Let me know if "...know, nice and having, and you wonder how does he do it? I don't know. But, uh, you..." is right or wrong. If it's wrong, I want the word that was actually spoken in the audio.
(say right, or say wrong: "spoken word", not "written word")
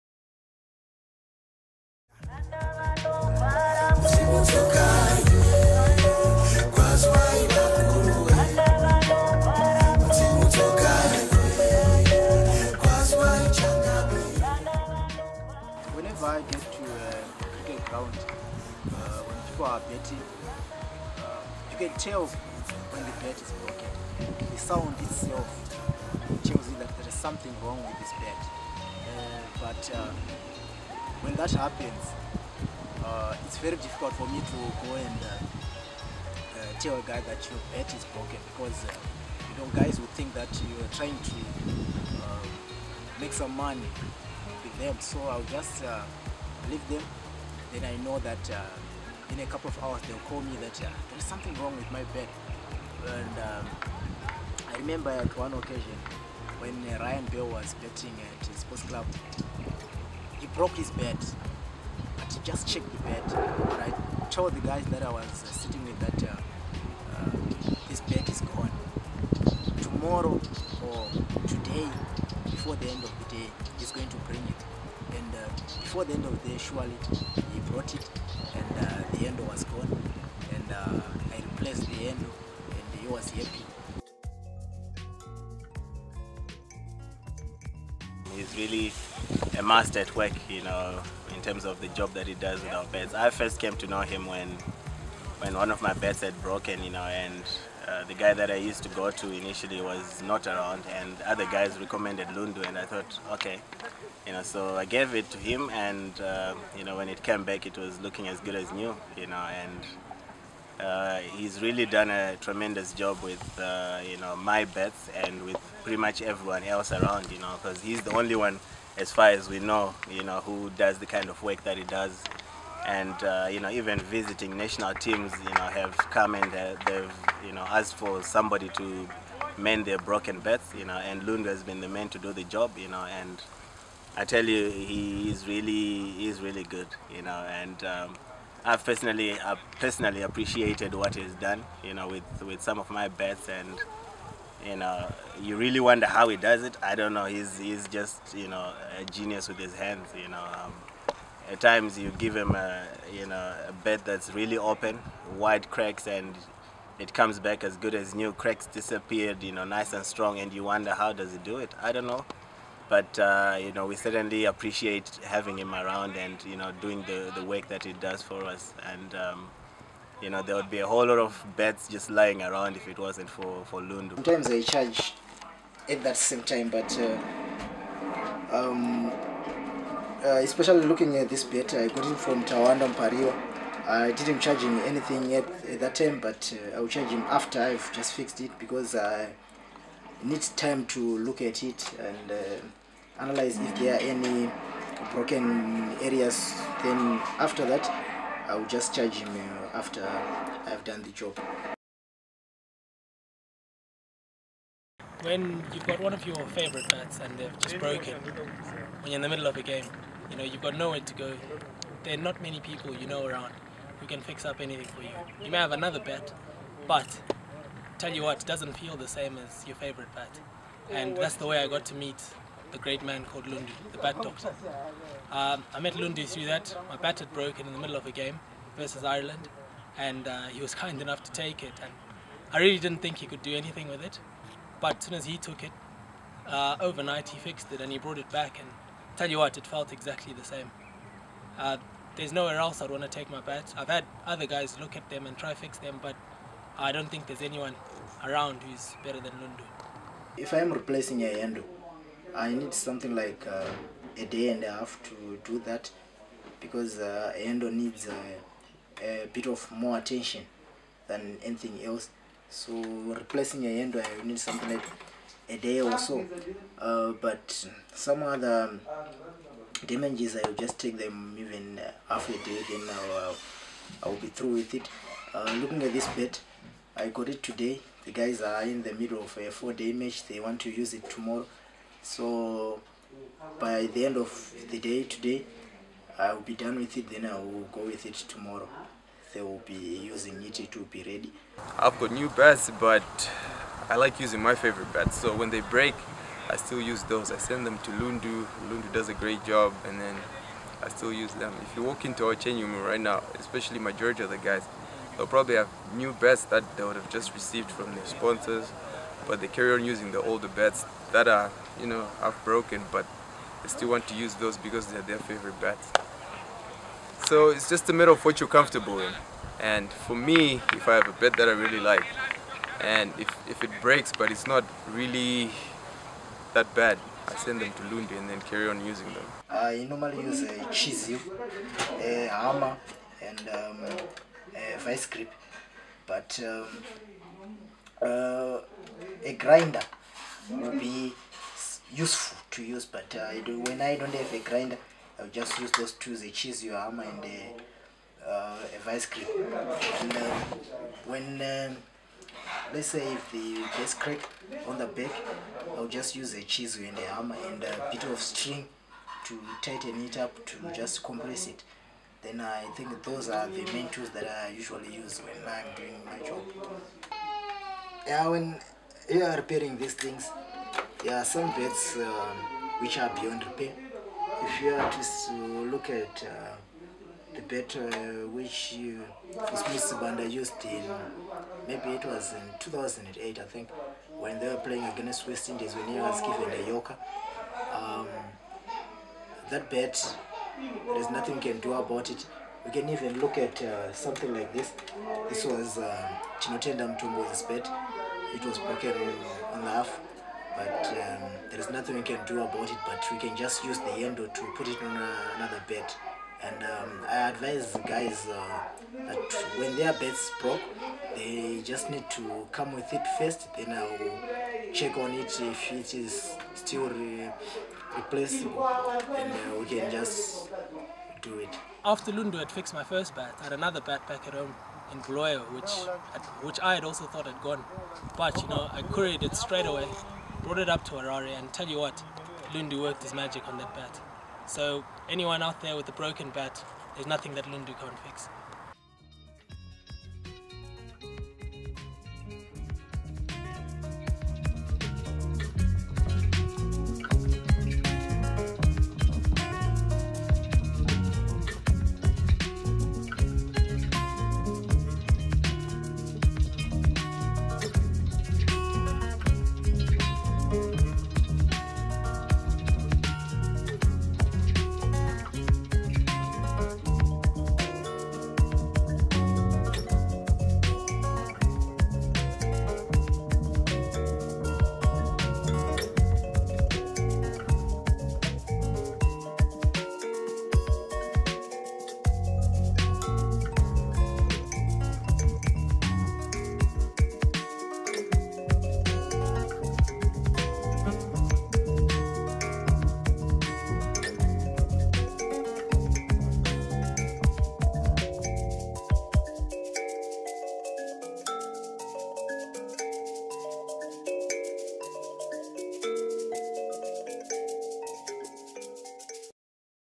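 wrong: "strong", not "having".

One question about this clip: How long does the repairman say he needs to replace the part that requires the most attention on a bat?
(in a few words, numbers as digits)
a day and a half.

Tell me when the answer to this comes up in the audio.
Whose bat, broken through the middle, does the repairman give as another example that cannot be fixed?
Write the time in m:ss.
6:36.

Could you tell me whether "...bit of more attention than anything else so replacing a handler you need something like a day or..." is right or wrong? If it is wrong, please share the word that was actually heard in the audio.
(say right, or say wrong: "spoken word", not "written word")
right.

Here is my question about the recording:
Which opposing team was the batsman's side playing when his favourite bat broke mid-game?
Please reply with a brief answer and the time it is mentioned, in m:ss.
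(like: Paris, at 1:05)
Ireland, at 3:49.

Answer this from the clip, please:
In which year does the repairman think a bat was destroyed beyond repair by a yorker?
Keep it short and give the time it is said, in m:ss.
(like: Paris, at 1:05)
2008, at 6:22.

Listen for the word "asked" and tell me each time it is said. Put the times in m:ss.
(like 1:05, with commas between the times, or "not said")
2:07.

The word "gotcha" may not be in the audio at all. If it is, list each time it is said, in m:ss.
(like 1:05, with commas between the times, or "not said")
not said.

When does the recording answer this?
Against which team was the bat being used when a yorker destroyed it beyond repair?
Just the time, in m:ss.
6:25.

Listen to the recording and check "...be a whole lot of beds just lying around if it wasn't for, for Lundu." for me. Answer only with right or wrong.
right.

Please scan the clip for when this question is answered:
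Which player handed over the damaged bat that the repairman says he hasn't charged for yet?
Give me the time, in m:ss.
3:02.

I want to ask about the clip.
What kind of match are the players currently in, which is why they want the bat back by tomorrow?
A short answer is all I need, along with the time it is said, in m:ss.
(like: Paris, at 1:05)
four day match, at 4:39.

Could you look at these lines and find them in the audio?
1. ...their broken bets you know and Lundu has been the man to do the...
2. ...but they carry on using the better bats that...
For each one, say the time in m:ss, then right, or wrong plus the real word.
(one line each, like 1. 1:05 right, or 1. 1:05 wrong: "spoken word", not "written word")
1. 2:09 right
2. 5:09 wrong: "older", not "better".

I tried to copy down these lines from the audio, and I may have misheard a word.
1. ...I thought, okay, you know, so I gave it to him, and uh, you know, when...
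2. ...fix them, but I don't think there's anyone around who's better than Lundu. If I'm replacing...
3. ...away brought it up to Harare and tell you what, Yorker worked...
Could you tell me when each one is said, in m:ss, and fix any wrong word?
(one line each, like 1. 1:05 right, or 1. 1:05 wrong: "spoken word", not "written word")
1. 1:42 right
2. 4:05 right
3. 7:09 wrong: "Lundu", not "Yorker".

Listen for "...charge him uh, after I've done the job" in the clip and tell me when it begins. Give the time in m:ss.
3:18.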